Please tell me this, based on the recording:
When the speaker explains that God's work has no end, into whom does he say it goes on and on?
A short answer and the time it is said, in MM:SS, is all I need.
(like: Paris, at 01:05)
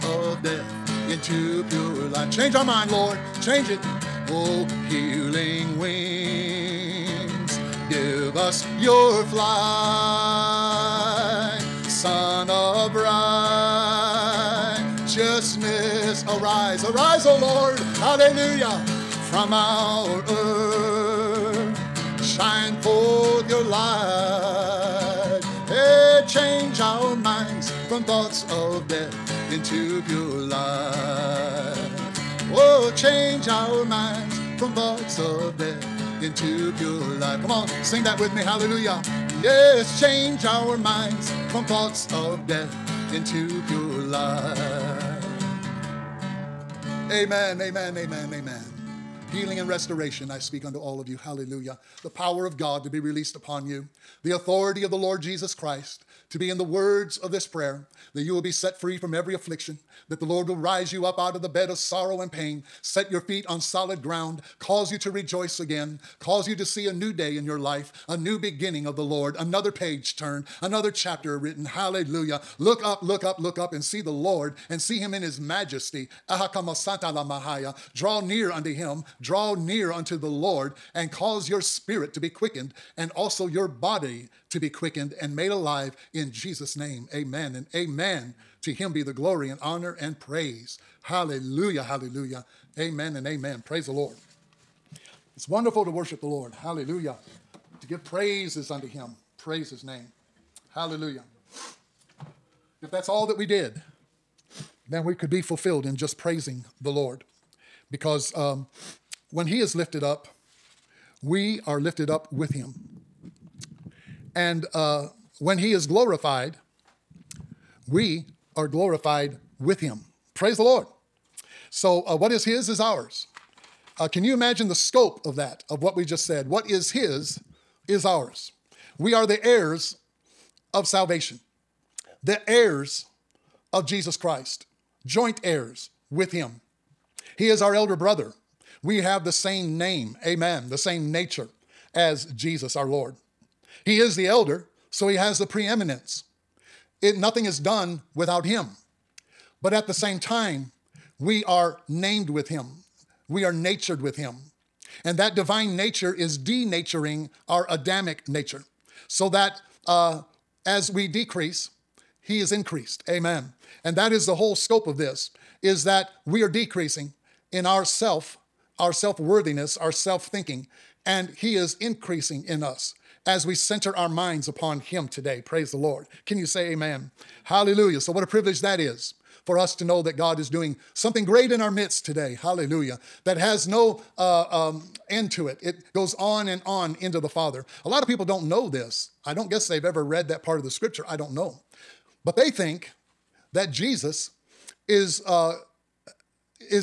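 the Father, at 03:07.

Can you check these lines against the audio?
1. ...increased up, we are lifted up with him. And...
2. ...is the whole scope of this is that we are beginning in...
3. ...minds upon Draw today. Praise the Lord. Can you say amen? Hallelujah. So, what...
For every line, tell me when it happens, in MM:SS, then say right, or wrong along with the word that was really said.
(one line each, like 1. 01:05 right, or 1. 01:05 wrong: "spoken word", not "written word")
1. 01:49 wrong: "lifted", not "increased"
2. 02:44 wrong: "decreasing", not "beginning"
3. 02:54 wrong: "Him", not "Draw".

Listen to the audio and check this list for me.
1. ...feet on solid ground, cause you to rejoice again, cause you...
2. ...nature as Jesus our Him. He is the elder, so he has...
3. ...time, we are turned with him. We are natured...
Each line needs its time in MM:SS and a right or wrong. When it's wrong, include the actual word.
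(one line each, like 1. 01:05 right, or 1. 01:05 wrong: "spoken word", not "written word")
1. 01:03 right
2. 02:21 wrong: "Lord", not "Him"
3. 02:30 wrong: "named", not "turned".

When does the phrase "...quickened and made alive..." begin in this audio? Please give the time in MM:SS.
01:24.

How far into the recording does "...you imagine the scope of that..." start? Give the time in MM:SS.
02:04.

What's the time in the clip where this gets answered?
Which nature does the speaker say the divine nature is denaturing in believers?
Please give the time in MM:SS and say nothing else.
02:37.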